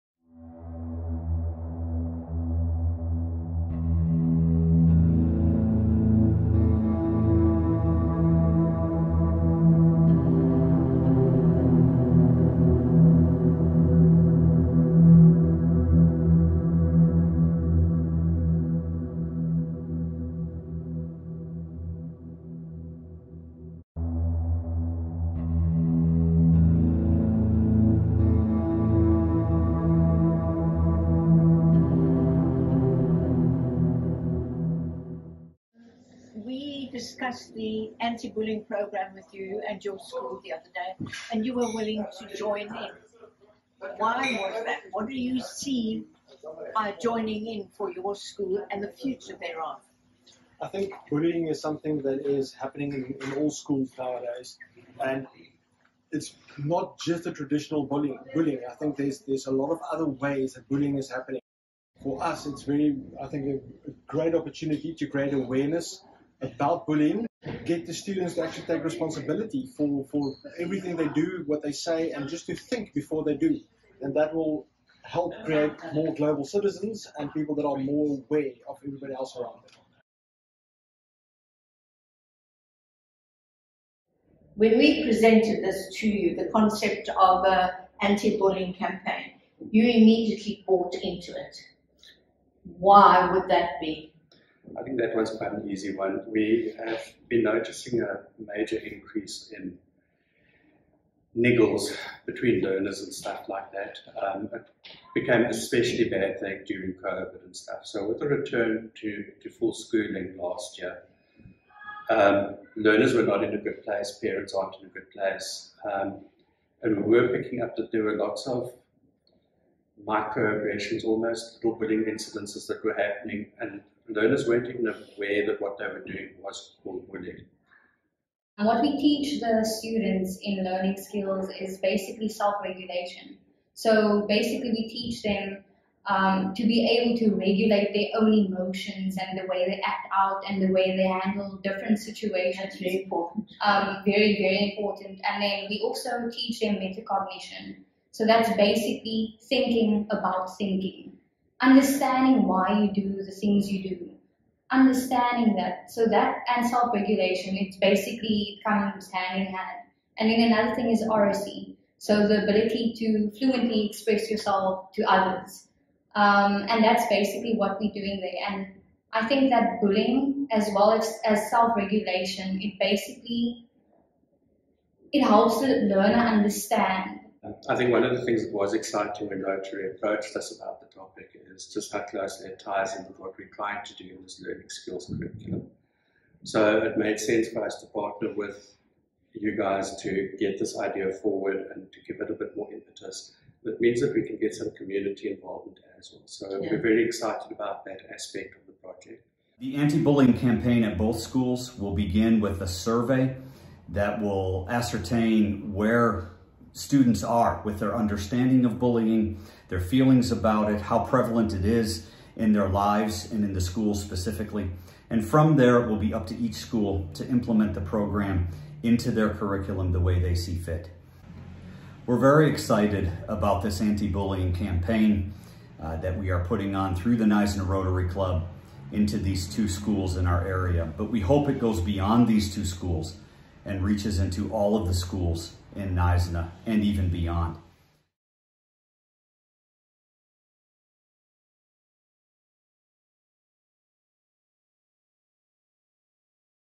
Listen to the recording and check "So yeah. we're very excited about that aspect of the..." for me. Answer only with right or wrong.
right.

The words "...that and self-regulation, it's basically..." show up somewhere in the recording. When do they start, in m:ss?
2:36.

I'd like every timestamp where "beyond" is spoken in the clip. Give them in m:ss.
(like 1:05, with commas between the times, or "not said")
3:51, 3:57.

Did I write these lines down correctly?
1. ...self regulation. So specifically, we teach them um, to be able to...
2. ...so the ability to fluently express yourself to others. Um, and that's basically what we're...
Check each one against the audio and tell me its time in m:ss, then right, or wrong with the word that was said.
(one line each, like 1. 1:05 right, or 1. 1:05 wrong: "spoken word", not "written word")
1. 2:12 wrong: "basically", not "specifically"
2. 2:41 right.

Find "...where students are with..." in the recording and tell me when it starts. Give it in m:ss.
3:25.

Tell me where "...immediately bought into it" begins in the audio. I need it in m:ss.
1:29.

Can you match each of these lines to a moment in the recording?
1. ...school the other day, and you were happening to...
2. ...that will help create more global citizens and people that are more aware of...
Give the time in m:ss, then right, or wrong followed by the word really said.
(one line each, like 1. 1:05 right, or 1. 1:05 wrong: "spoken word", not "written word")
1. 0:39 wrong: "willing", not "happening"
2. 1:14 right.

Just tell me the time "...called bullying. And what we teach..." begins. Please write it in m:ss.
2:06.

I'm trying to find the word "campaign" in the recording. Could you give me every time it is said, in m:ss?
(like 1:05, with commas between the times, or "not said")
1:28, 3:20, 3:44.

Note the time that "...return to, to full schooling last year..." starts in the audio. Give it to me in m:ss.
1:48.